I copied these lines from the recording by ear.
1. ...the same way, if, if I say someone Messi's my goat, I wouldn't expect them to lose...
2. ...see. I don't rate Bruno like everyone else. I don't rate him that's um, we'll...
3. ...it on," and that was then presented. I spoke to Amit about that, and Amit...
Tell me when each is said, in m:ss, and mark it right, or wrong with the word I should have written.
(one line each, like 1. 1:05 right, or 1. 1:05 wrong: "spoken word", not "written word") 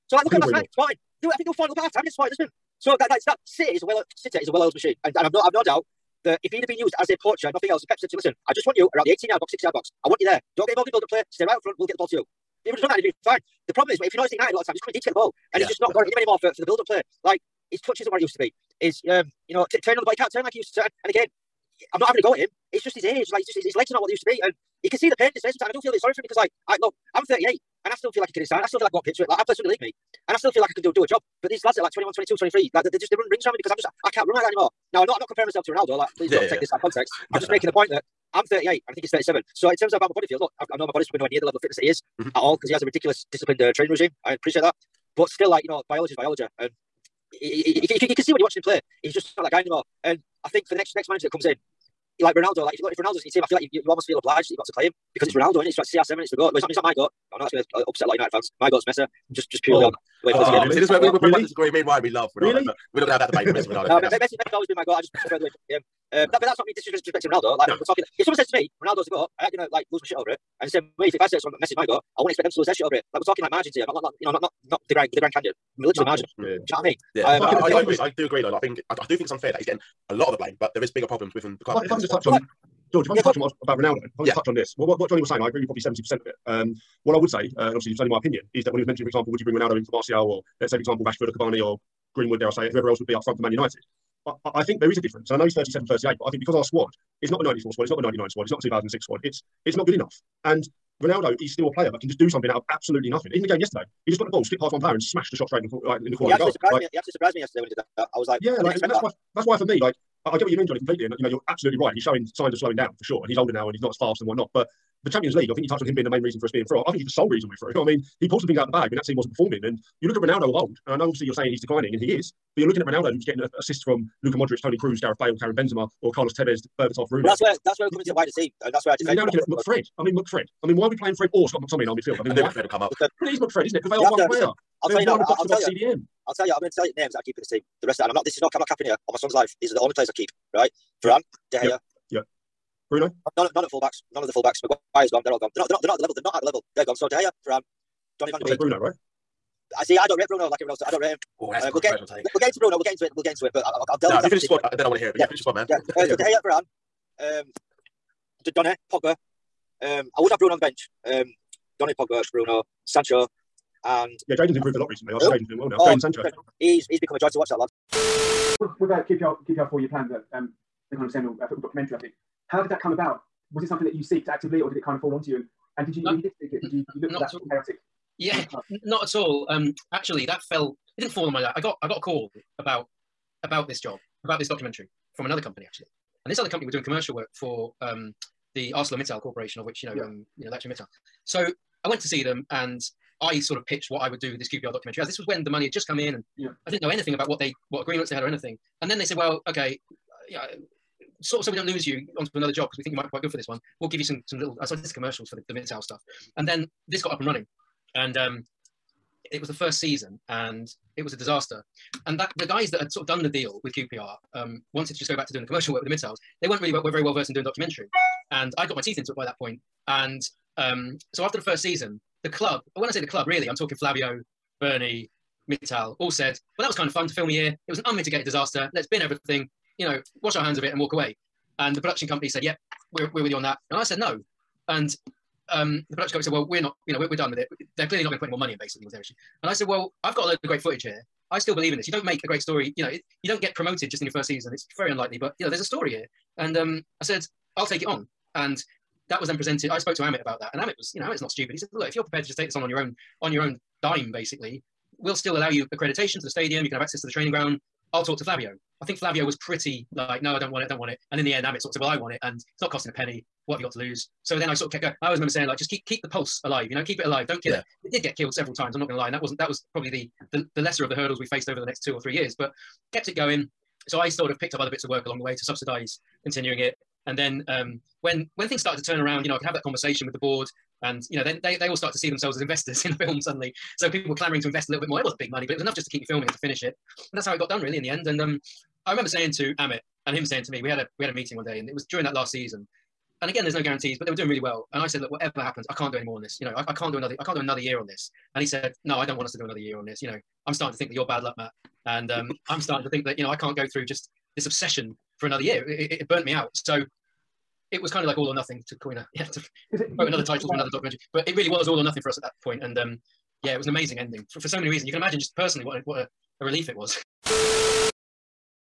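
1. 1:10 right
2. 2:29 right
3. 4:07 right.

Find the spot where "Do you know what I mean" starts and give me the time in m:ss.
1:16.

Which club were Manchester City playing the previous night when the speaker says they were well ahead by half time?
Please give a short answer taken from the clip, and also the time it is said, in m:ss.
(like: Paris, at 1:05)
Sporting Lisbon, at 0:02.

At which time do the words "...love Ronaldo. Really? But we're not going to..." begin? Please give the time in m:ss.
1:02.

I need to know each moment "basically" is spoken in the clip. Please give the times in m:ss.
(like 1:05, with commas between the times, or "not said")
3:58, 4:14.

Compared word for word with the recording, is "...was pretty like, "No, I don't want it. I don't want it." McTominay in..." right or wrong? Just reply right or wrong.
wrong.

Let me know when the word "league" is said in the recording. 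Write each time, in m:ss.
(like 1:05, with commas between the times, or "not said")
0:29, 1:55.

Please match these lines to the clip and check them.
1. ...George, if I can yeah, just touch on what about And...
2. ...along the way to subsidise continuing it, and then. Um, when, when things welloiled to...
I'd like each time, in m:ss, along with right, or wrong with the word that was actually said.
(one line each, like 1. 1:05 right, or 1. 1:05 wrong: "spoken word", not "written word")
1. 1:22 wrong: "Ronaldo", not "And"
2. 4:35 wrong: "started", not "welloiled".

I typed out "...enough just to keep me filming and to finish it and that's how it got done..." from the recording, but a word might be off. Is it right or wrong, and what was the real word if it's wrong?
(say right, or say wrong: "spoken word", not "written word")
right.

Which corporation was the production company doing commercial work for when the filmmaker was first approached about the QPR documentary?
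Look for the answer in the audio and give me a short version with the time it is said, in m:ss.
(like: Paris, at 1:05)
ArcelorMittal, at 3:08.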